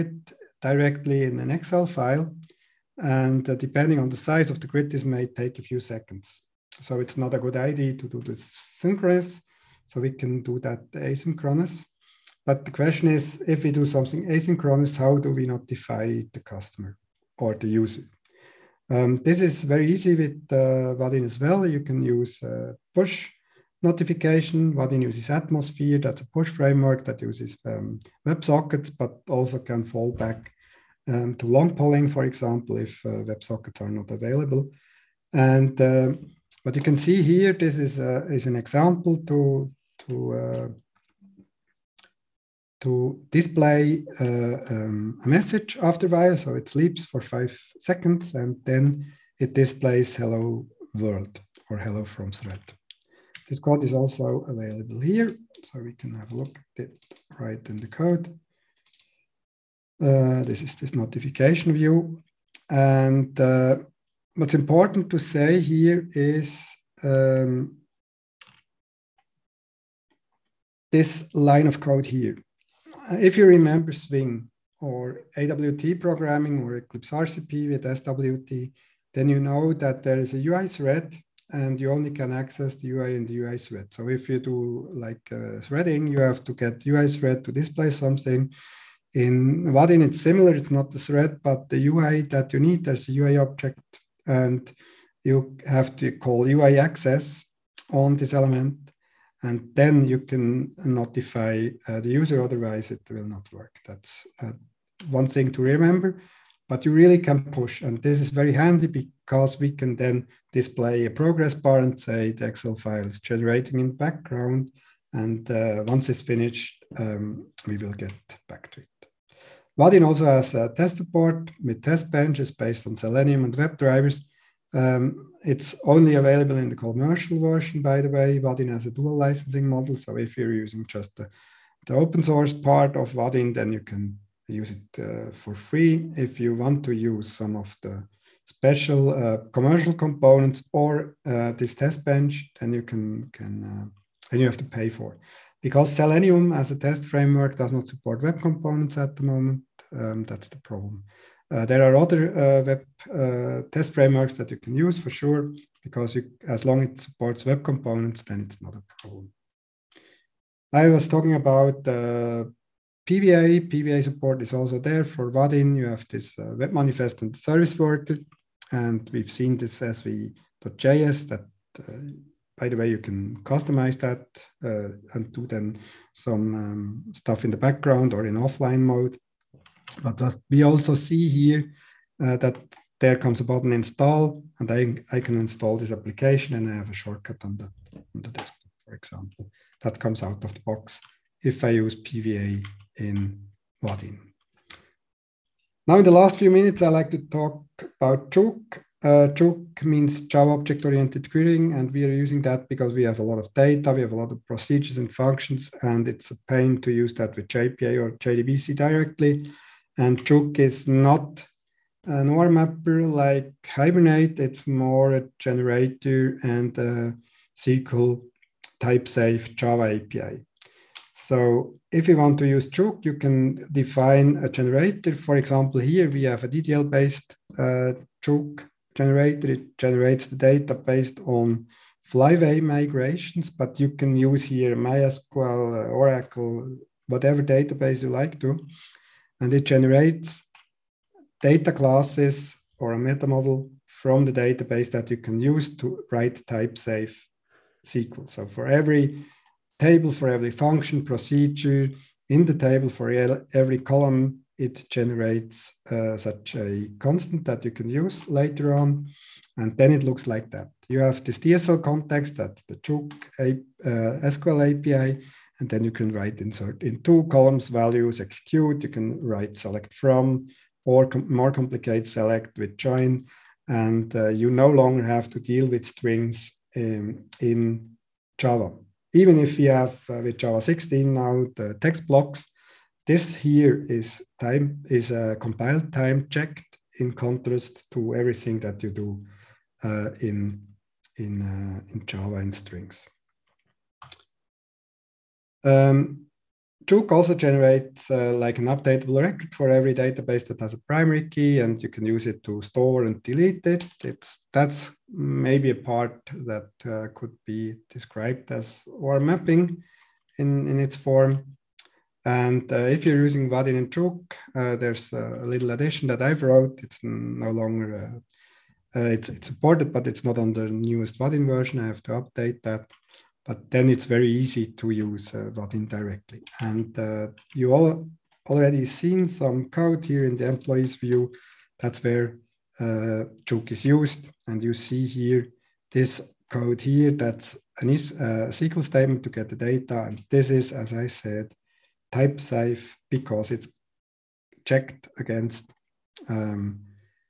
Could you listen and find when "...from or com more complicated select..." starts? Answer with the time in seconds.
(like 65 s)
269 s.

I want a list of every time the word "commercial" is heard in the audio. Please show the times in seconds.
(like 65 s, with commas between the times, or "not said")
126 s, 139 s.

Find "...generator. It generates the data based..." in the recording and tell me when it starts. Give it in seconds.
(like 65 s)
228 s.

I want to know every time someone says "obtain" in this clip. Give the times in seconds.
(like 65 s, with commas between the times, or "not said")
not said.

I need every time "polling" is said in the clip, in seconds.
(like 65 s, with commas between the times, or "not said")
31 s.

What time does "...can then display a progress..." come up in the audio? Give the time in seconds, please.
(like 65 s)
109 s.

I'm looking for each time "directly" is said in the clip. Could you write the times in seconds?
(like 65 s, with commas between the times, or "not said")
0 s, 208 s, 325 s.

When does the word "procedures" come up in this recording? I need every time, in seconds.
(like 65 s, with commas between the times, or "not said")
204 s, 251 s.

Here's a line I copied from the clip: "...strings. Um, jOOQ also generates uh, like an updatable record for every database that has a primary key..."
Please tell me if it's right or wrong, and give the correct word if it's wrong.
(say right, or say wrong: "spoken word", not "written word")
right.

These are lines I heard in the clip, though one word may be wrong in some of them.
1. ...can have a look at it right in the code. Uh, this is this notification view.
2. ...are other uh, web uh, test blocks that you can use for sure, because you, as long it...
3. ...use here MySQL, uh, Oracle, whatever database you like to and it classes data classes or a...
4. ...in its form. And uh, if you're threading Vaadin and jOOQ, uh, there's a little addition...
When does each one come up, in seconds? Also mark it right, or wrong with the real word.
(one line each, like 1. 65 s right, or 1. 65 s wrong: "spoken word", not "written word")
1. 55 s right
2. 151 s wrong: "frameworks", not "blocks"
3. 234 s wrong: "generates", not "classes"
4. 310 s wrong: "using", not "threading".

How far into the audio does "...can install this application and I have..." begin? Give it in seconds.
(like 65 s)
185 s.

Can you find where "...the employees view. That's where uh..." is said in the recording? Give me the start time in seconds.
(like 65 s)
330 s.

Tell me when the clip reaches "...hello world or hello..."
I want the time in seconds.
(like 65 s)
50 s.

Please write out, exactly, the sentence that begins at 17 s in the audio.
or to use Um, this is very easy with uh, Vaadin as well.